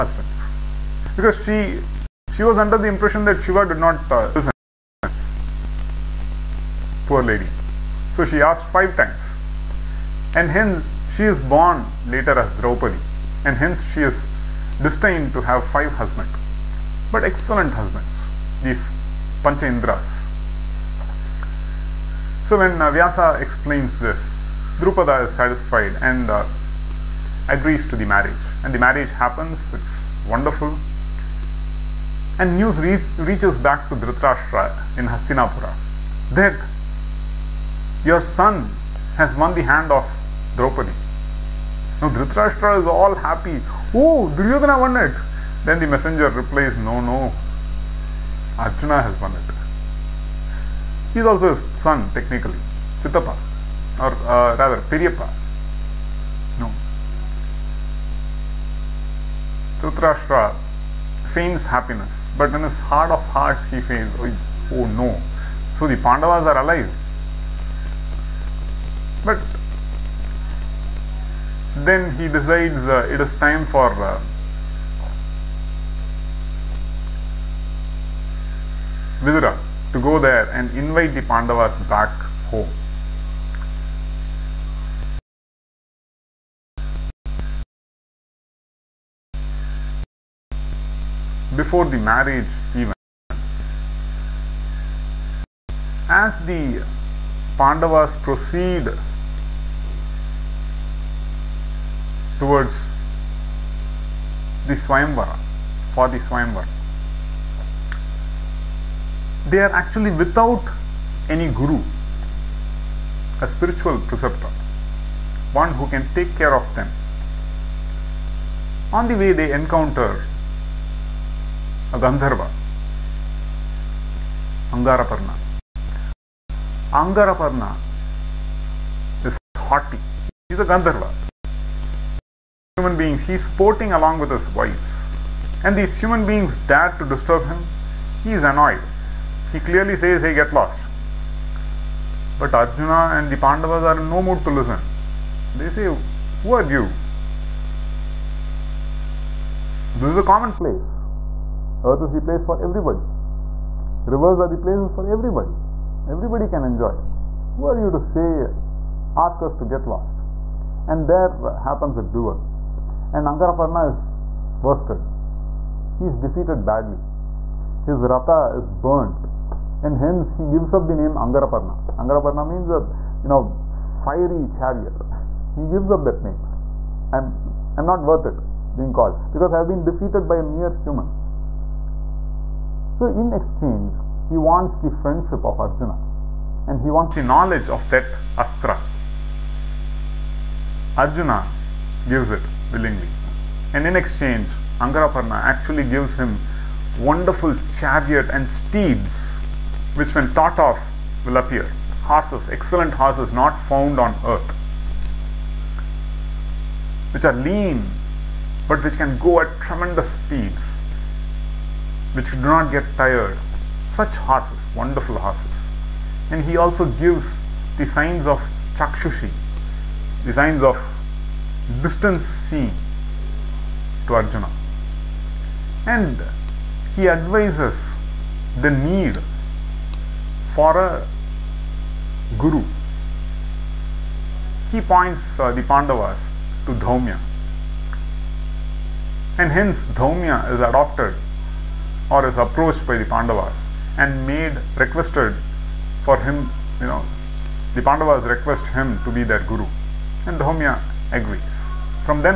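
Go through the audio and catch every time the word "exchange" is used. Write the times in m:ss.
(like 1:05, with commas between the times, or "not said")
3:03, 3:13.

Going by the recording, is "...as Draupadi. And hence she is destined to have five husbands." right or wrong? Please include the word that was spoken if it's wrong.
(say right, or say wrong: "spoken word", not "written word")
right.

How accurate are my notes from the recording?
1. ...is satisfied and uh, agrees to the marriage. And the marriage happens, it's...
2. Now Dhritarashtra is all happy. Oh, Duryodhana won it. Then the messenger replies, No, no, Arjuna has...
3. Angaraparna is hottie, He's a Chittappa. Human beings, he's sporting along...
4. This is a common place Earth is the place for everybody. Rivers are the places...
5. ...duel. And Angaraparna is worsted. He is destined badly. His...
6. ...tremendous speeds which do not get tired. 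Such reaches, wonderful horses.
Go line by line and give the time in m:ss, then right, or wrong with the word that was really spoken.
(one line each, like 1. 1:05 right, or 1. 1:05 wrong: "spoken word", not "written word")
1. 0:25 right
2. 0:42 right
3. 2:06 wrong: "Gandharva", not "Chittappa"
4. 2:29 right
5. 2:42 wrong: "defeated", not "destined"
6. 3:29 wrong: "horses", not "reaches".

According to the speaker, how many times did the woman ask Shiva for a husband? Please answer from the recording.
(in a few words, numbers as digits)
5.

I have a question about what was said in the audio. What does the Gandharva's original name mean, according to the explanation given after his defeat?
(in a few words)
fiery chariot.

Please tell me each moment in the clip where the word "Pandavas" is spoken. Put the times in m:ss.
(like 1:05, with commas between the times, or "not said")
1:05, 1:21, 1:37, 2:23, 3:55, 4:03, 4:07.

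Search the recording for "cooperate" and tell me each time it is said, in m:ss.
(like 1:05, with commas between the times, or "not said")
not said.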